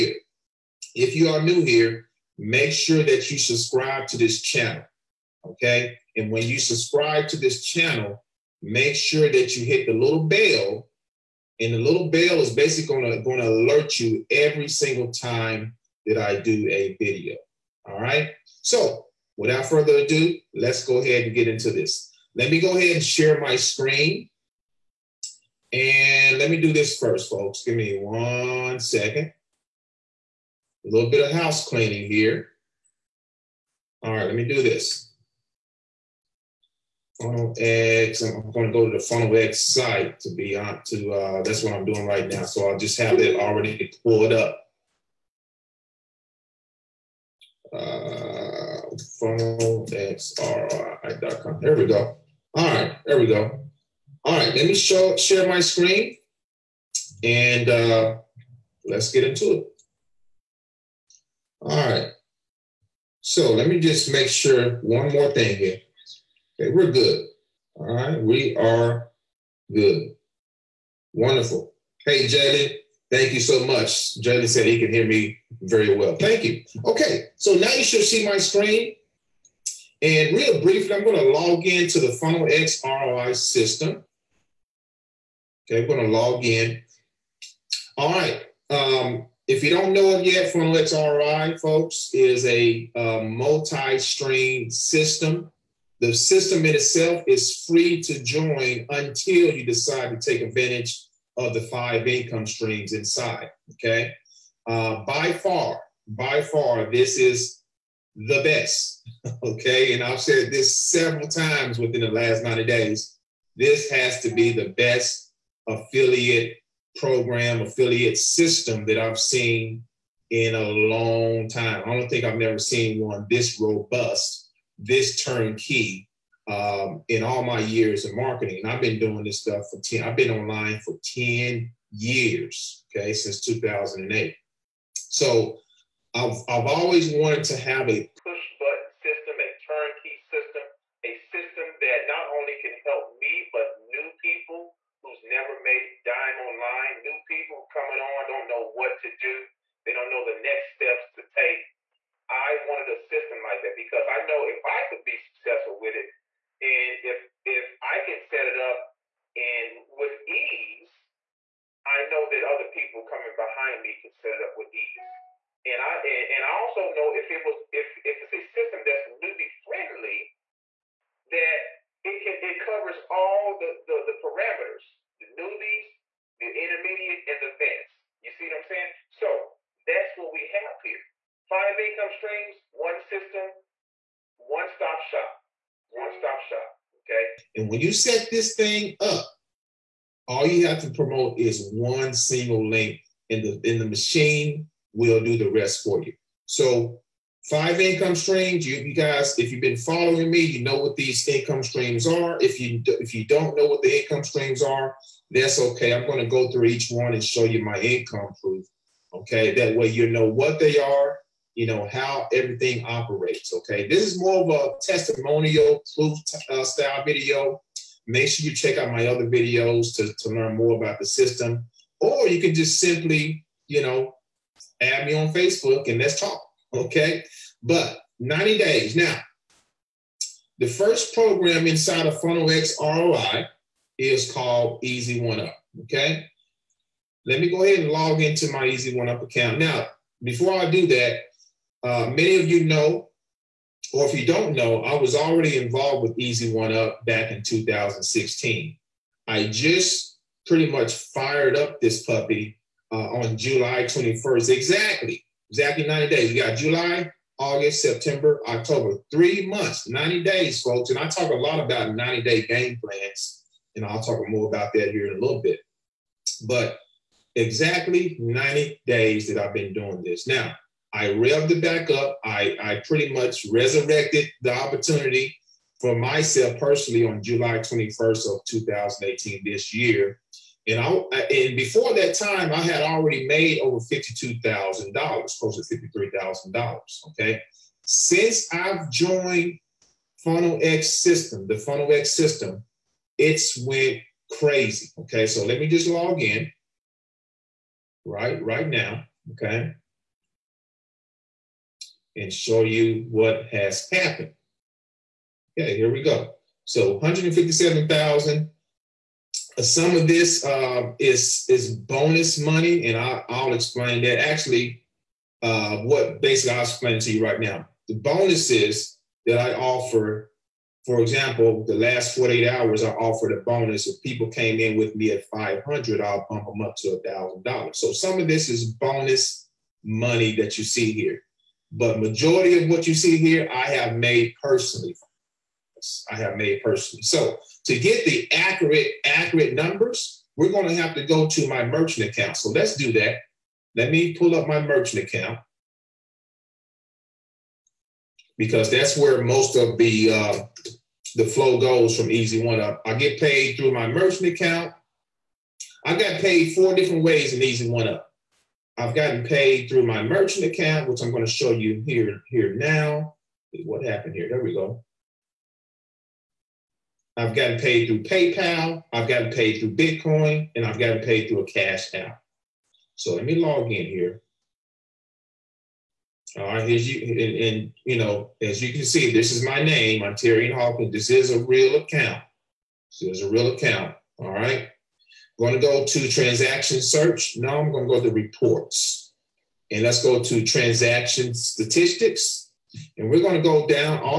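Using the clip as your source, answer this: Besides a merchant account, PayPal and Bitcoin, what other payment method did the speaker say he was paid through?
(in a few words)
cash app.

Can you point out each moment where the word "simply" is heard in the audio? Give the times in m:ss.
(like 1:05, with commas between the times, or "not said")
3:42.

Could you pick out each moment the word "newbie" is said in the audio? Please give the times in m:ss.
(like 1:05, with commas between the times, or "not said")
2:49, 2:55.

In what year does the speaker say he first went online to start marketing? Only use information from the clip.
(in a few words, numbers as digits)
2008.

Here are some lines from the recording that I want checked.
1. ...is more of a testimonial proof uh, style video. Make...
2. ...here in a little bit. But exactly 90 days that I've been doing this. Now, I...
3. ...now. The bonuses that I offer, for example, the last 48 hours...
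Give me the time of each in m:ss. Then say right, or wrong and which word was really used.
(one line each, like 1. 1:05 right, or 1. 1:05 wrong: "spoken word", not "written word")
1. 3:34 right
2. 4:24 right
3. 5:17 right.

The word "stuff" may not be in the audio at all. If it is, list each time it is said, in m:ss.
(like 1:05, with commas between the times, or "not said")
2:09.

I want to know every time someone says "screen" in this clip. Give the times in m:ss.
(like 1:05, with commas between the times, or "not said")
0:23, 0:55, 1:18.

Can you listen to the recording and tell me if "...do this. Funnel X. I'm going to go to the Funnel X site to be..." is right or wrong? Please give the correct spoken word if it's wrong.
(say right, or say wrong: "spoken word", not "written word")
right.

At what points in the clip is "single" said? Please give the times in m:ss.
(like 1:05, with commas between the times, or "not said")
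0:14, 3:12.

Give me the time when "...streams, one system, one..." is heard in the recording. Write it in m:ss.
3:02.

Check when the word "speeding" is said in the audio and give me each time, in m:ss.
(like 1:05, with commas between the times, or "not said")
not said.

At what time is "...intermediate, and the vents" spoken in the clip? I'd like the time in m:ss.
2:56.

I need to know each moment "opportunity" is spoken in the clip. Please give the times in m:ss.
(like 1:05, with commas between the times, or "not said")
4:34.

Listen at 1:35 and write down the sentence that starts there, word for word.
The system in itself is free to join until you decide to take advantage of the five income streams inside.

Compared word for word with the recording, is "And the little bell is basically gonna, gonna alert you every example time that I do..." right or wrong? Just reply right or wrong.
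wrong.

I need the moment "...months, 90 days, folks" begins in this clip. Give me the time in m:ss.
4:19.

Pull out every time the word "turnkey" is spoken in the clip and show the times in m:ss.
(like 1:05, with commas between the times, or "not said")
2:05, 2:19.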